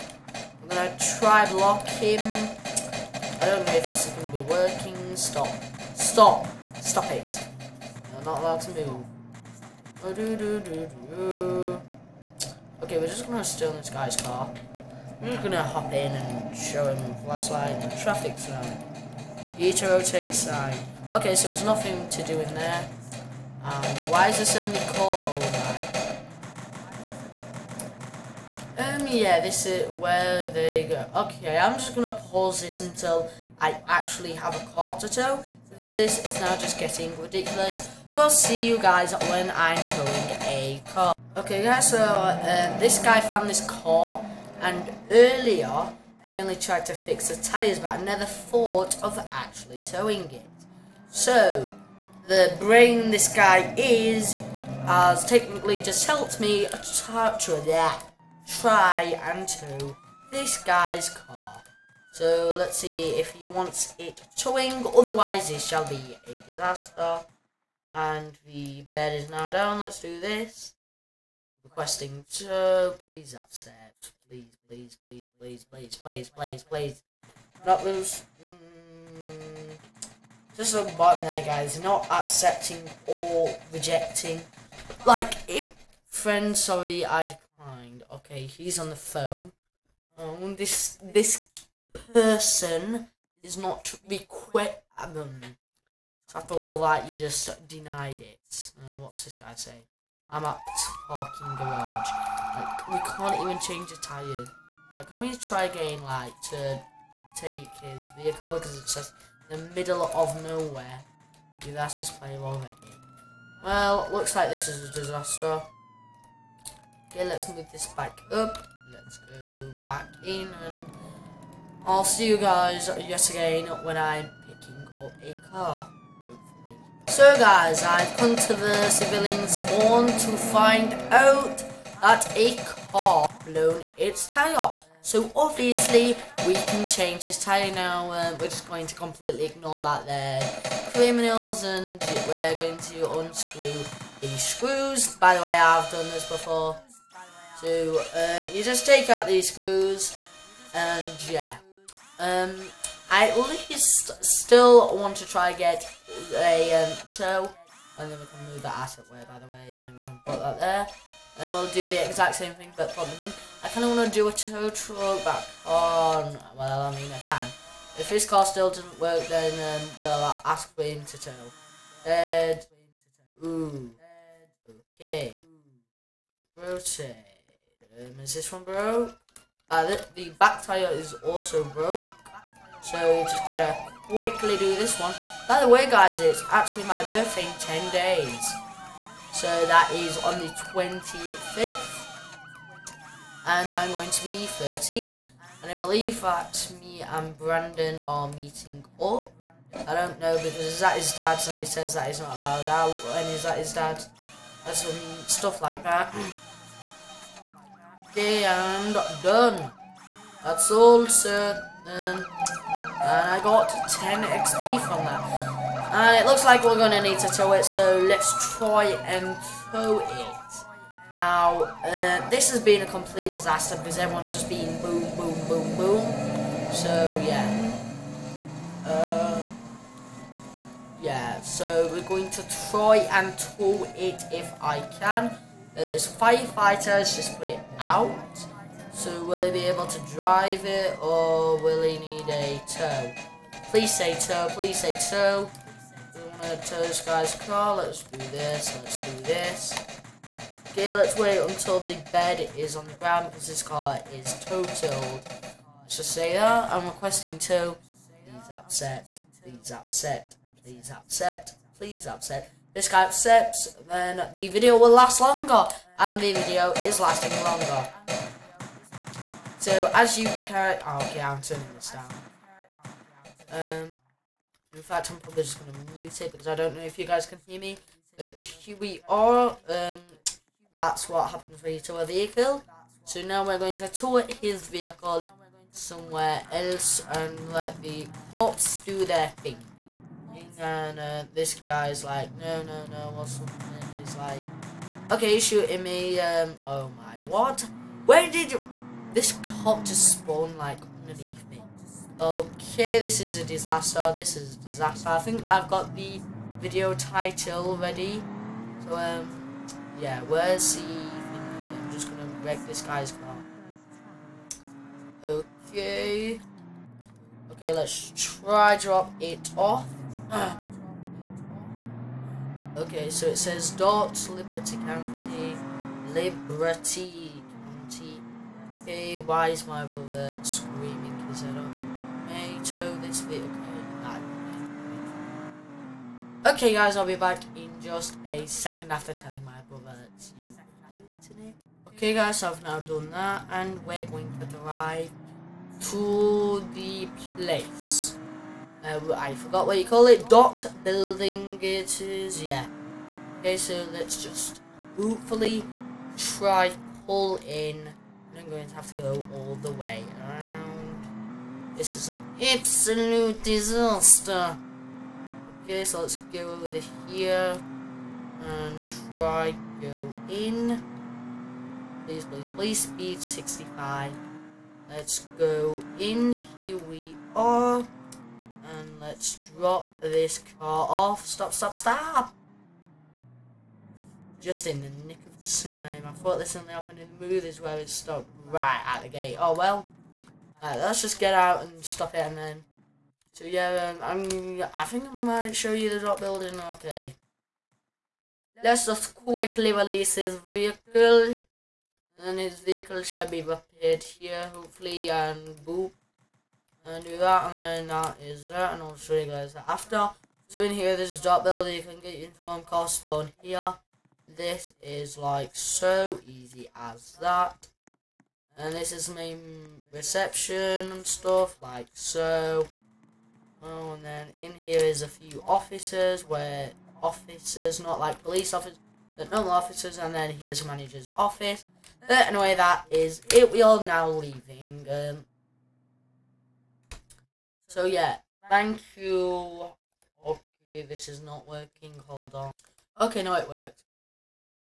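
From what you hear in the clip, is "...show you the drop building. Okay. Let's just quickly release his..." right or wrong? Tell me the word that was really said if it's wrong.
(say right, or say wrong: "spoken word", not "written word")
right.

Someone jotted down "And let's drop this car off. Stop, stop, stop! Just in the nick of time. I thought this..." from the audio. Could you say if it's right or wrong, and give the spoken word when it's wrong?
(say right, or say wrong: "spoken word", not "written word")
right.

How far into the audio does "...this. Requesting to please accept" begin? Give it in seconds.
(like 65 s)
70 s.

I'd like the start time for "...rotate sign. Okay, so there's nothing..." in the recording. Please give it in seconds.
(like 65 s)
19 s.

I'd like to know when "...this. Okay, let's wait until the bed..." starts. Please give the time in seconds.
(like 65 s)
249 s.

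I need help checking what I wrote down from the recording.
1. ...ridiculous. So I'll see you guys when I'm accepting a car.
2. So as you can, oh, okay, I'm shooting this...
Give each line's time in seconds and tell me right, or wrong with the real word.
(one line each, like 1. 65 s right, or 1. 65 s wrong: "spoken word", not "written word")
1. 37 s wrong: "towing", not "accepting"
2. 269 s wrong: "turning", not "shooting".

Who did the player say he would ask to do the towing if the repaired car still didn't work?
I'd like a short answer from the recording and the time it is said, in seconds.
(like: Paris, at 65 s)
Wayne, at 170 s.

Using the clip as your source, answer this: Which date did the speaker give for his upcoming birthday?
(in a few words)
the 25th.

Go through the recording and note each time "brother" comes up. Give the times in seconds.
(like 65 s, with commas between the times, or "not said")
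329 s, 339 s.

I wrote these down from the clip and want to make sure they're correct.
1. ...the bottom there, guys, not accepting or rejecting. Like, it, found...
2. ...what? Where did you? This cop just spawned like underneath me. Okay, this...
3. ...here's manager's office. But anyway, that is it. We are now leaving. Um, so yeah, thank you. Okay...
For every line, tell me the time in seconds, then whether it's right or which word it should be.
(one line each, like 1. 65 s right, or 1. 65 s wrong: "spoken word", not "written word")
1. 80 s wrong: "friend", not "found"
2. 297 s right
3. 430 s right.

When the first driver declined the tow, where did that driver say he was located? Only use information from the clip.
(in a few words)
parking garage.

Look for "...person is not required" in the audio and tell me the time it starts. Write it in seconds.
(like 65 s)
92 s.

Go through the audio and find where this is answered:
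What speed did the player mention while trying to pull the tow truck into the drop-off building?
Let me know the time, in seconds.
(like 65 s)
373 s.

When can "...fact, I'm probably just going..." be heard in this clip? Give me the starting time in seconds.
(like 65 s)
274 s.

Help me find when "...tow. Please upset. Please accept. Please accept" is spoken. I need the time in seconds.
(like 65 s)
257 s.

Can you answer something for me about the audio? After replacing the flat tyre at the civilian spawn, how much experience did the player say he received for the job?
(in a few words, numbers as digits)
10 XP.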